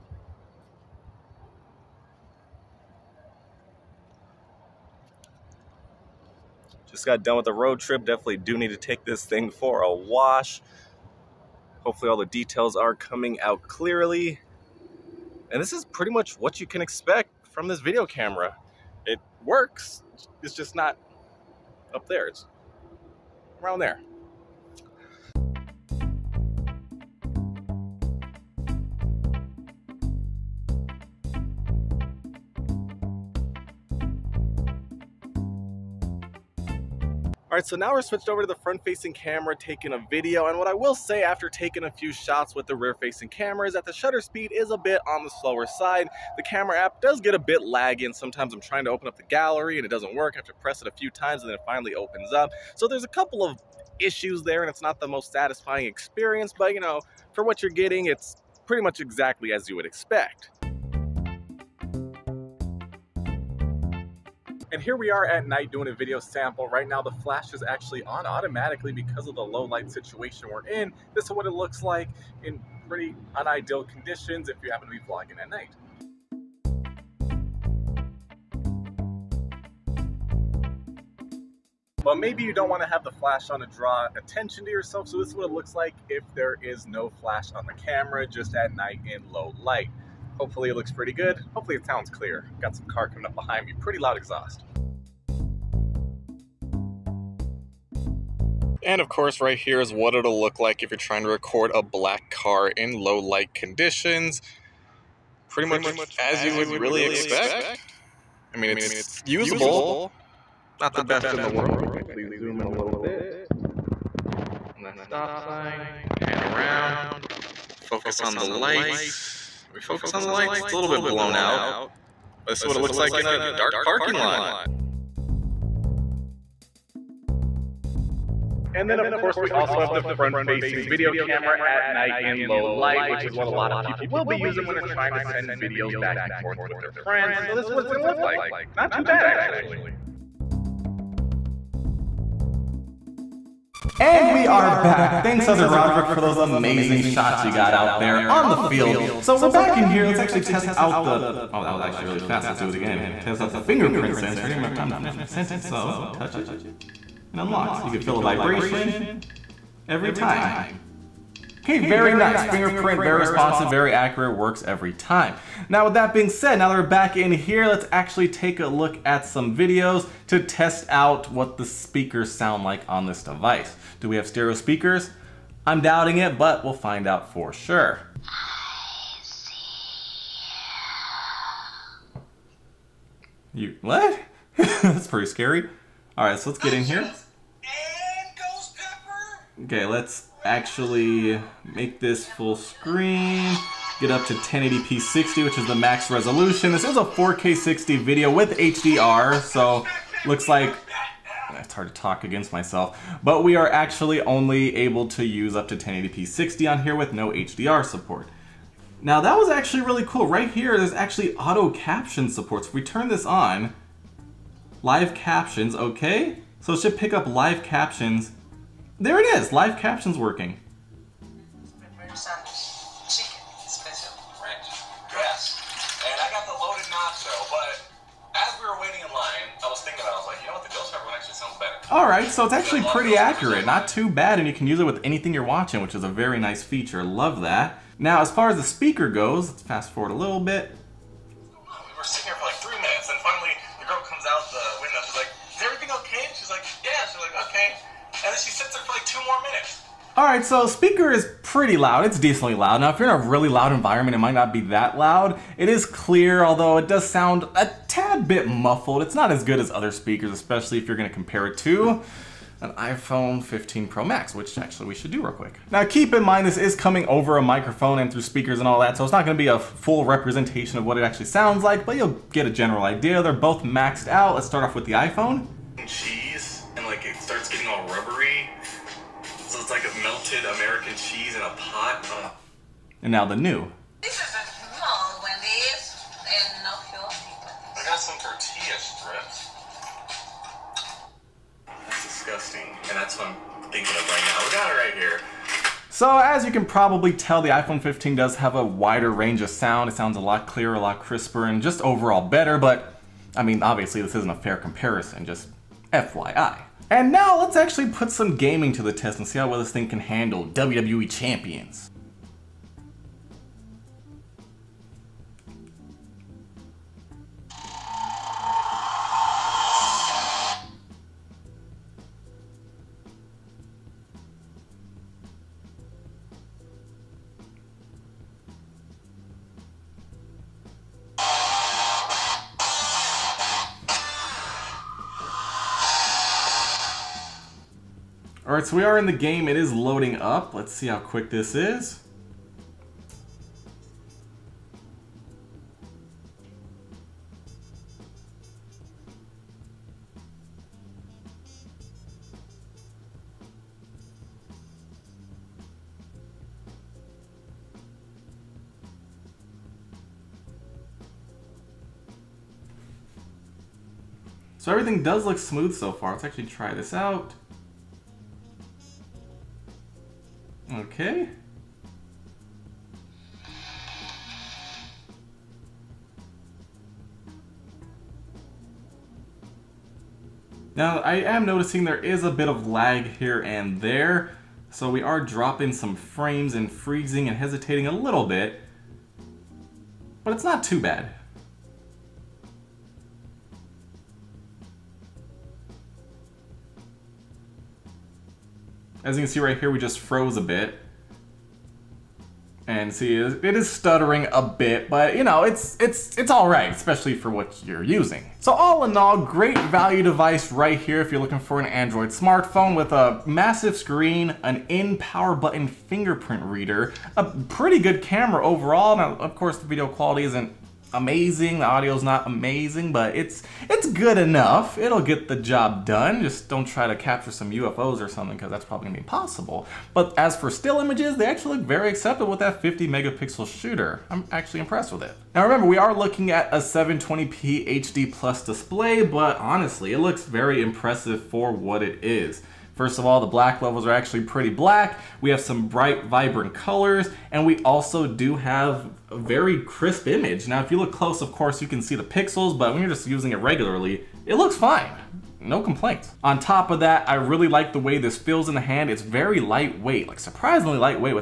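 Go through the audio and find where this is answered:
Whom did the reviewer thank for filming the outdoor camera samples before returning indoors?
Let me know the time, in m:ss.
2:25.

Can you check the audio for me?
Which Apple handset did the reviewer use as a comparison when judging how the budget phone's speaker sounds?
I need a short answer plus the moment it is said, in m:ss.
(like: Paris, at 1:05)
iPhone 15 Pro Max, at 4:22.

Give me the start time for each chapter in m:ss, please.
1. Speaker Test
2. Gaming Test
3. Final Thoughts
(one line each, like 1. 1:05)
1. 4:42
2. 5:07
3. 6:48.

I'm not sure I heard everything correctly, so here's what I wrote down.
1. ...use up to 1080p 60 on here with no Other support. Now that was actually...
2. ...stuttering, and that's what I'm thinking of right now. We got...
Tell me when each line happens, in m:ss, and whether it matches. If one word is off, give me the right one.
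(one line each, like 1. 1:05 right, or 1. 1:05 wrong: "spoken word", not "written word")
1. 3:25 wrong: "HDR", not "Other"
2. 4:52 wrong: "disgusting", not "stuttering".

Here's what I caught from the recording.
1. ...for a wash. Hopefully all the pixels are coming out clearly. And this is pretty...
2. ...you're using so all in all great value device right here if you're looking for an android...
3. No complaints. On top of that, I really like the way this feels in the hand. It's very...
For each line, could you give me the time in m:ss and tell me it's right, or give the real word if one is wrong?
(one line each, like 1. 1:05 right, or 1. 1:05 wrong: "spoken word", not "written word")
1. 0:09 wrong: "details", not "pixels"
2. 6:47 right
3. 7:35 right.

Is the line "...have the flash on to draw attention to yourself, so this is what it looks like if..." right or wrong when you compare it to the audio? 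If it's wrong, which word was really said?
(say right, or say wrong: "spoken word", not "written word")
right.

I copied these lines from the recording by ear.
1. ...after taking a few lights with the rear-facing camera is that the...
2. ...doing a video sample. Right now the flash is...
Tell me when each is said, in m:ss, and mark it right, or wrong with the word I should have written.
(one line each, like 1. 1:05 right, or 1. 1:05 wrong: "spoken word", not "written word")
1. 0:41 wrong: "shots", not "lights"
2. 1:05 right.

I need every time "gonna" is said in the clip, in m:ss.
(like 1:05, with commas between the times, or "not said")
2:17, 4:29, 7:08.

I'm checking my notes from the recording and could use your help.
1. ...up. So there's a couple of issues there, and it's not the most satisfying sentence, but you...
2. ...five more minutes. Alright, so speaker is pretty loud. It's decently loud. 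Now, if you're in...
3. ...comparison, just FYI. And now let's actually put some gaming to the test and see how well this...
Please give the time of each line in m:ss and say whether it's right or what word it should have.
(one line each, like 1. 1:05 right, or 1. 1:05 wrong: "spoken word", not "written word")
1. 0:52 wrong: "experience", not "sentence"
2. 4:09 wrong: "two", not "five"
3. 5:04 right.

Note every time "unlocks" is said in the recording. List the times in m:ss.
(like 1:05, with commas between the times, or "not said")
2:37.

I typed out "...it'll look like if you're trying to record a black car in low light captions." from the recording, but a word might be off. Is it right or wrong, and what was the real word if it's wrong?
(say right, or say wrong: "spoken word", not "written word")
wrong: "conditions", not "captions".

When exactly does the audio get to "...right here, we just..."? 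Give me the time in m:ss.
6:39.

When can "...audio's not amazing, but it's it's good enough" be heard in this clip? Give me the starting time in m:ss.
7:01.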